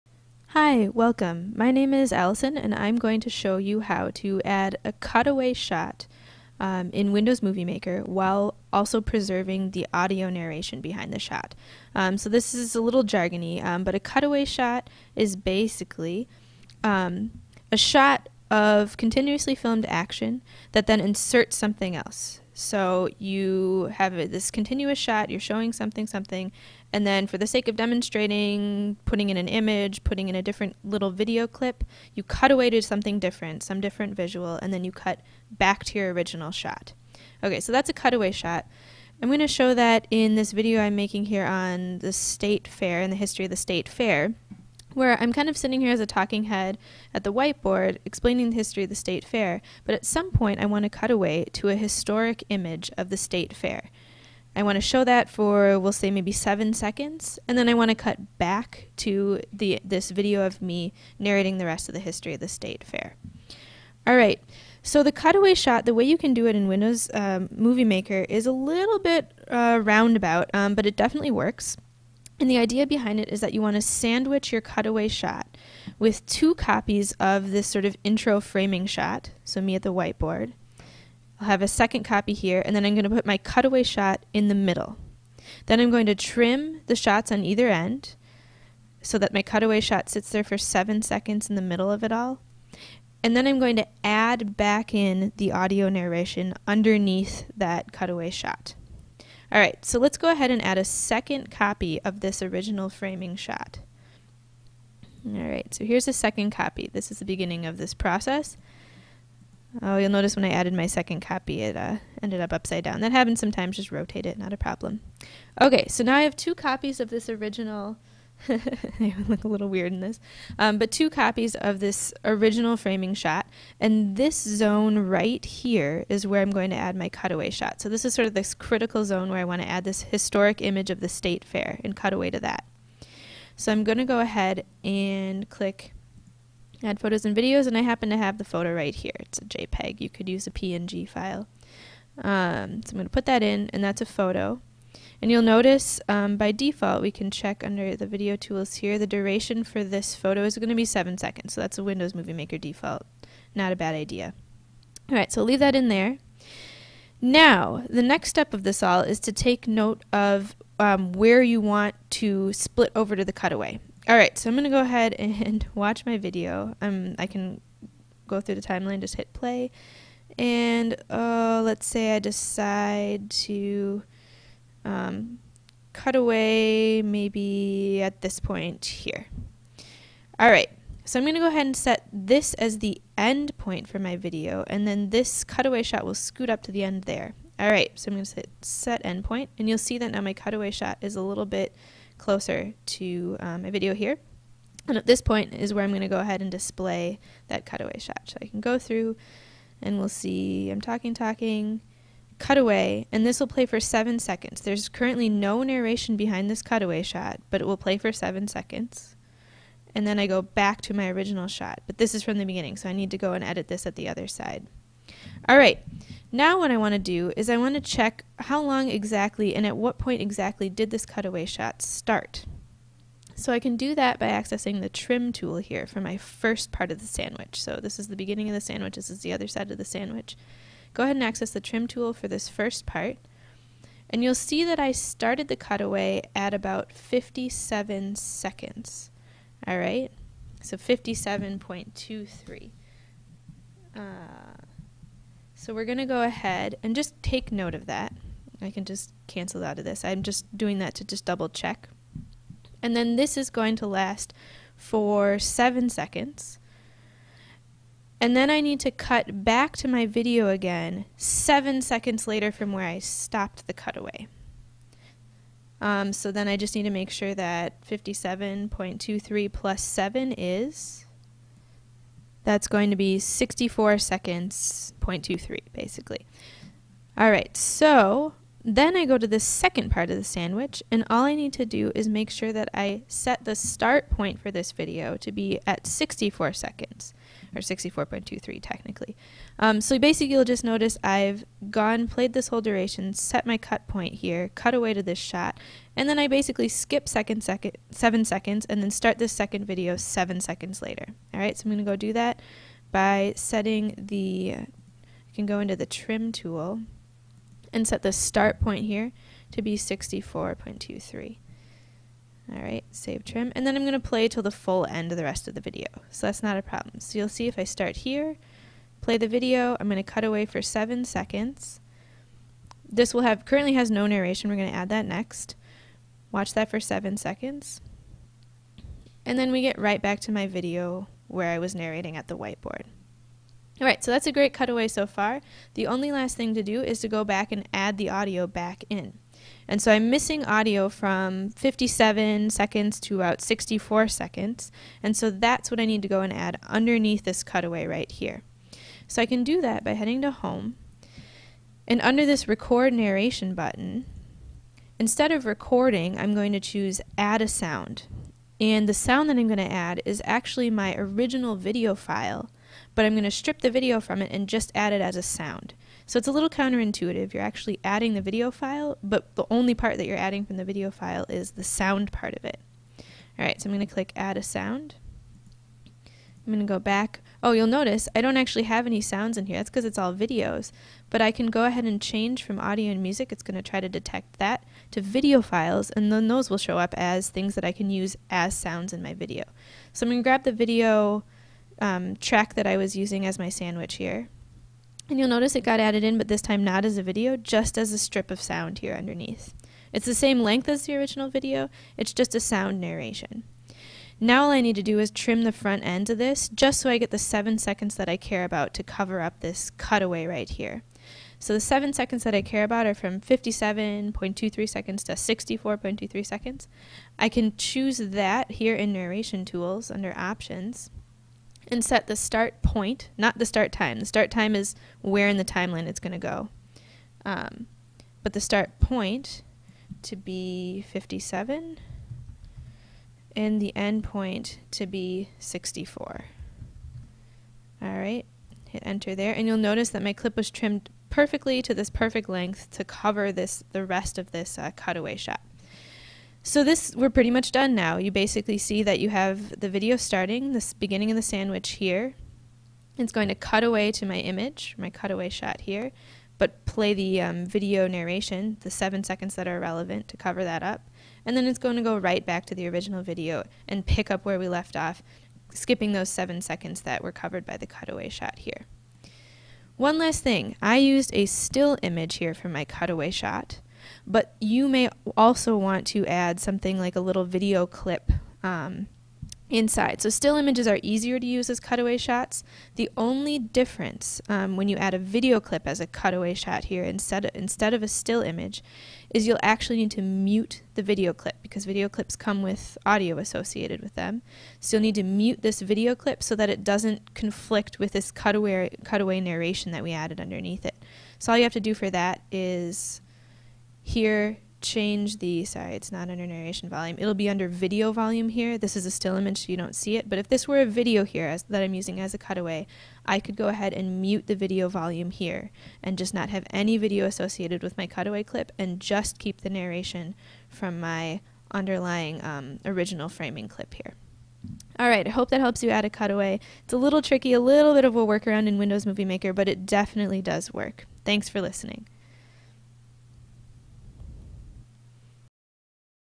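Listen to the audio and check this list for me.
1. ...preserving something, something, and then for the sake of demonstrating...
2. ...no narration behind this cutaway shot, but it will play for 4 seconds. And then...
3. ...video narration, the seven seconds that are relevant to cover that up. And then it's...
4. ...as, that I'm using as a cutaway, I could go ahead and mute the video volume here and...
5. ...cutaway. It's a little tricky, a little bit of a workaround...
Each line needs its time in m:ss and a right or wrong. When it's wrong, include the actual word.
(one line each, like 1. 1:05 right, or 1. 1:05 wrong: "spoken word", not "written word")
1. 0:25 wrong: "showing", not "preserving"
2. 3:25 wrong: "7", not "4"
3. 7:37 right
4. 8:31 right
5. 8:45 right.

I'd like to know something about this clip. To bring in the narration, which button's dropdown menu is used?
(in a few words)
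record narration.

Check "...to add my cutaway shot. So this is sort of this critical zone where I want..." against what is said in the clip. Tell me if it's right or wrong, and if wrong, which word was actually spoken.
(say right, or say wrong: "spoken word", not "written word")
right.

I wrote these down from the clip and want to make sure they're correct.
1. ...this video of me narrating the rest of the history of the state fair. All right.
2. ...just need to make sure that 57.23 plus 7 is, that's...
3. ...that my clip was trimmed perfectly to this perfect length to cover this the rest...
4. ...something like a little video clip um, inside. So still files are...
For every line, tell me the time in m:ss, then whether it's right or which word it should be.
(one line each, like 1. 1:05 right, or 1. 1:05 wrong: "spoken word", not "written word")
1. 0:59 right
2. 4:26 right
3. 7:19 right
4. 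7:56 wrong: "images", not "files".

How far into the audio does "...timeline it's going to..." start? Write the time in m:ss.
7:05.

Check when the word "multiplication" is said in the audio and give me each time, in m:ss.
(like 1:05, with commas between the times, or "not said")
not said.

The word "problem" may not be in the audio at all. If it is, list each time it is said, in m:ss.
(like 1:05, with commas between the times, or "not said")
1:54, 5:16.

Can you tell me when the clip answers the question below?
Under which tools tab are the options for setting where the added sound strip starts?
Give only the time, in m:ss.
6:58.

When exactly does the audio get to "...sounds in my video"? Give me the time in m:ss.
6:28.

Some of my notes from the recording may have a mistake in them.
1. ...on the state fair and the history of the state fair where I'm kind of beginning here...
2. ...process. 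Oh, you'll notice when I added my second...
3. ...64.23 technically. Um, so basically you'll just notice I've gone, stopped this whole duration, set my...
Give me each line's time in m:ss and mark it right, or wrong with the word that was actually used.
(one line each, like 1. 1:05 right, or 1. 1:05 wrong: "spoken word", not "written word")
1. 0:41 wrong: "sitting", not "beginning"
2. 1:47 right
3. 4:47 wrong: "played", not "stopped".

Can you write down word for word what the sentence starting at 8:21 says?
So all you have to do for that is here, change the, sorry, it's not under narration volume.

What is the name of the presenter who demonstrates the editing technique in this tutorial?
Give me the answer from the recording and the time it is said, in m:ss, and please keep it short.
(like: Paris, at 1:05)
Allison, at 0:02.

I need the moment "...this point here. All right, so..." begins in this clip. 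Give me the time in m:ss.
2:58.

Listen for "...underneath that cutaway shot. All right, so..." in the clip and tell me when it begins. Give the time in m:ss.
1:36.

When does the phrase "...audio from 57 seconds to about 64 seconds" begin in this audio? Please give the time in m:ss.
5:40.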